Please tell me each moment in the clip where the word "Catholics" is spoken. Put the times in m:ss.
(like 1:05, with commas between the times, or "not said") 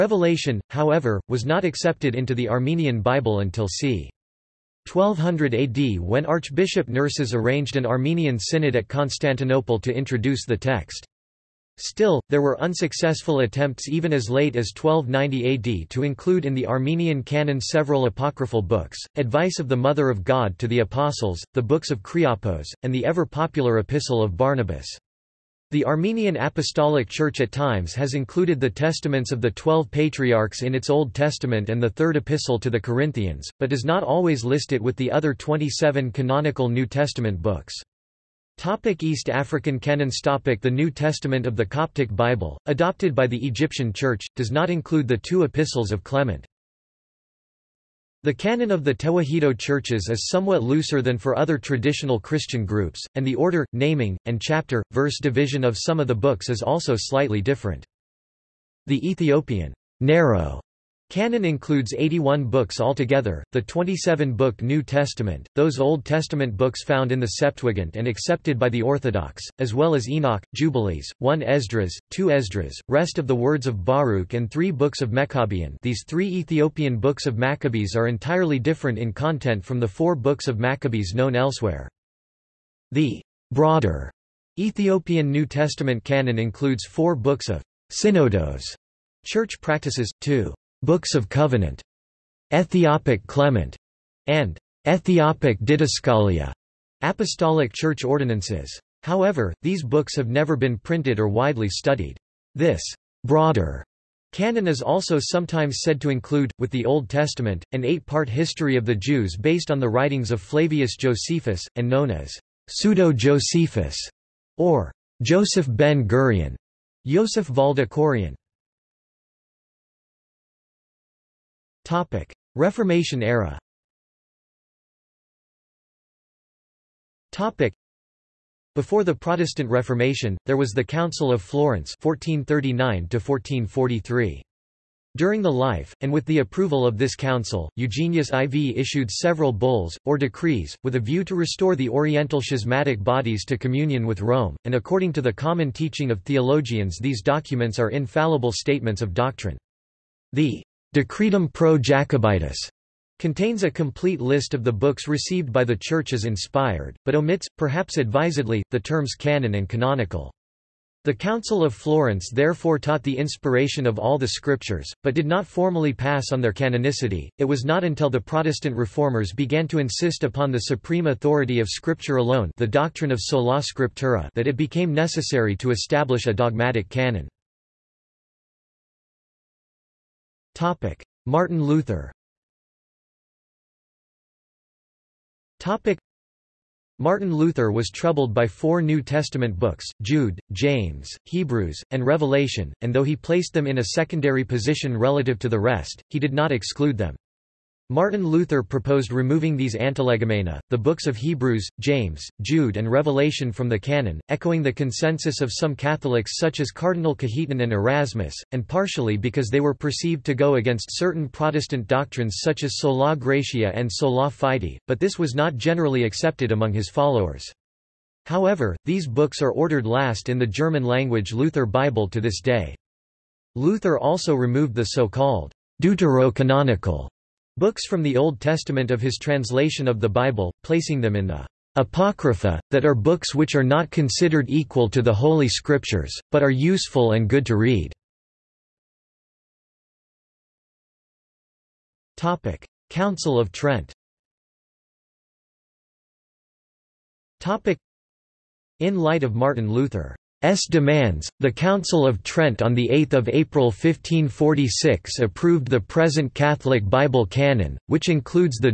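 3:25, 4:16.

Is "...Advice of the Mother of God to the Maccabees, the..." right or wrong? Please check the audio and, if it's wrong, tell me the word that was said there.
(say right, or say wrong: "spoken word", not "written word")
wrong: "Apostles", not "Maccabees".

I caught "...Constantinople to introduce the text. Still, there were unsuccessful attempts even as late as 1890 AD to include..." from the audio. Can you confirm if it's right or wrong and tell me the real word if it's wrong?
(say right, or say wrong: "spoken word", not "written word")
wrong: "1290", not "1890".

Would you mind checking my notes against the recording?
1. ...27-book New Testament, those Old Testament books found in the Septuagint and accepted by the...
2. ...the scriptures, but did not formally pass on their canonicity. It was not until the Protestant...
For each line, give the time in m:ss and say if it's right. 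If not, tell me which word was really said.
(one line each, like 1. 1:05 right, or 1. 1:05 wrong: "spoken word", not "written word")
1. 1:03 right
2. 2:44 right.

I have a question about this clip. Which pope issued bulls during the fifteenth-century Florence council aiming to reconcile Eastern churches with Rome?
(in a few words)
Eugenius IV.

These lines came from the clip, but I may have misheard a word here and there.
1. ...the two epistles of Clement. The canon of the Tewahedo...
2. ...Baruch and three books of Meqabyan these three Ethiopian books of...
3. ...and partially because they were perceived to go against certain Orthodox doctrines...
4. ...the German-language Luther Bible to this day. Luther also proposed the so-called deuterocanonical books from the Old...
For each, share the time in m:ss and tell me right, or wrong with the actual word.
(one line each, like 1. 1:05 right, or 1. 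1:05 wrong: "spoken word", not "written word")
1. 0:45 right
2. 1:13 right
3. 3:28 wrong: "Protestant", not "Orthodox"
4. 3:40 wrong: "removed", not "proposed".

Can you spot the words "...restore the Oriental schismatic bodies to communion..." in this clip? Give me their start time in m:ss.
2:21.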